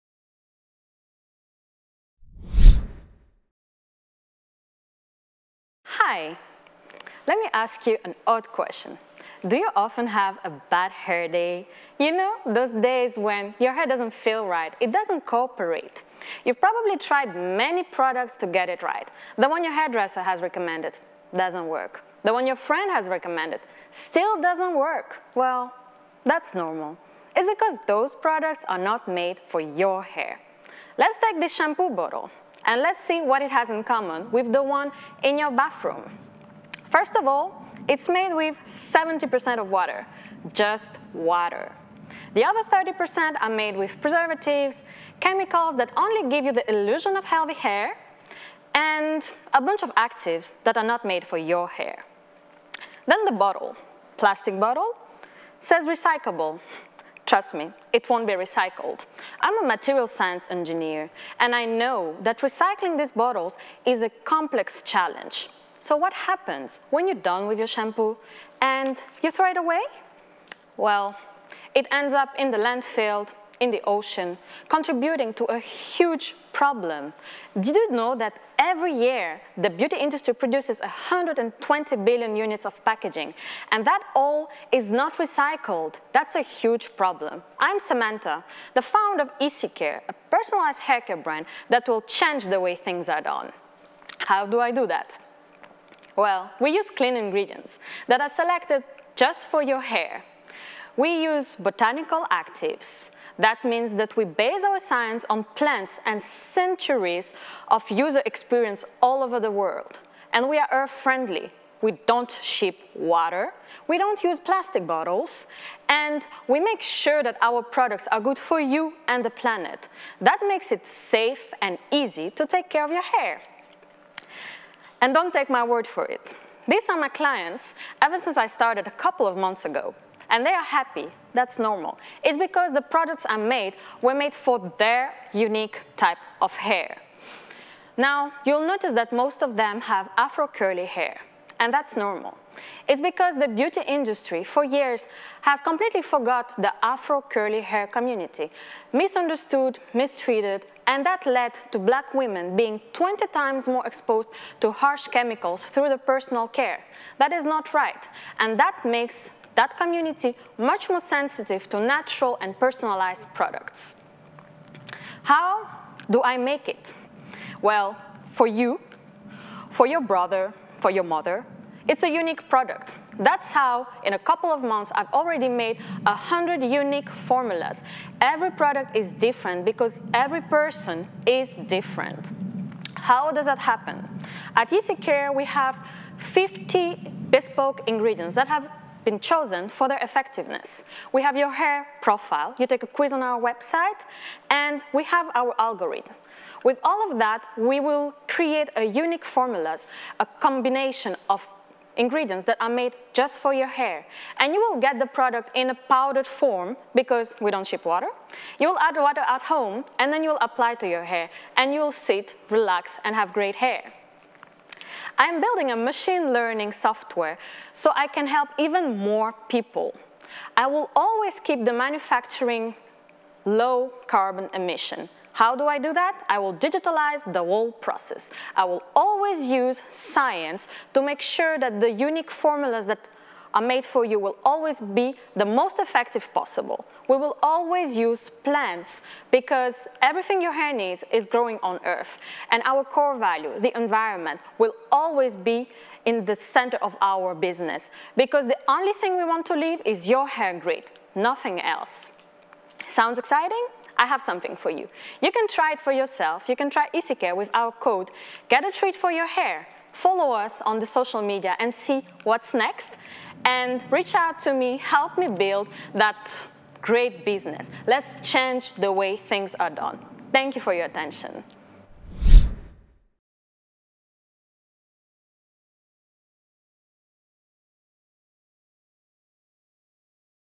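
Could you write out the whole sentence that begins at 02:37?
That is not right, and that makes that community much more sensitive to natural and personalized products.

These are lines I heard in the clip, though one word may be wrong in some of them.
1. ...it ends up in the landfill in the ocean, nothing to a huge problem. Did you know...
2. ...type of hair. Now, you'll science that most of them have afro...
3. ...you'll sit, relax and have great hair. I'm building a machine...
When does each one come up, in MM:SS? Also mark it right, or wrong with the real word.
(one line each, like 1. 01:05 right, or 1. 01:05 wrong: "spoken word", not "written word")
1. 01:11 wrong: "contributing", not "nothing"
2. 02:15 wrong: "notice", not "science"
3. 03:31 right.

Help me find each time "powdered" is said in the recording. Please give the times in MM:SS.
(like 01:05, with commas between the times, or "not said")
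03:25.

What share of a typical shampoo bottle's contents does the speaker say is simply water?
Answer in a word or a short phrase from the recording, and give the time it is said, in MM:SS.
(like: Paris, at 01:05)
70%, at 00:38.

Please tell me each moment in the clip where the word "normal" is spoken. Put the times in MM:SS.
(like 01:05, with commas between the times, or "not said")
00:26, 02:11, 02:21.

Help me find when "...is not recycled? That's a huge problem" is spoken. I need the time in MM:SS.
01:24.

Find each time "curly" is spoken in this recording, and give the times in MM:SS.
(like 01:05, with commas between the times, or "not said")
02:20, 02:27.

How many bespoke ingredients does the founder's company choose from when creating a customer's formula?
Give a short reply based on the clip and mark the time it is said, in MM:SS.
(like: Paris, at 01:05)
50, at 03:06.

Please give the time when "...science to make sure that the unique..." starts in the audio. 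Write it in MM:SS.
03:49.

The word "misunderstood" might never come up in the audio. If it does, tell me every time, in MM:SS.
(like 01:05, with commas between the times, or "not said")
02:28.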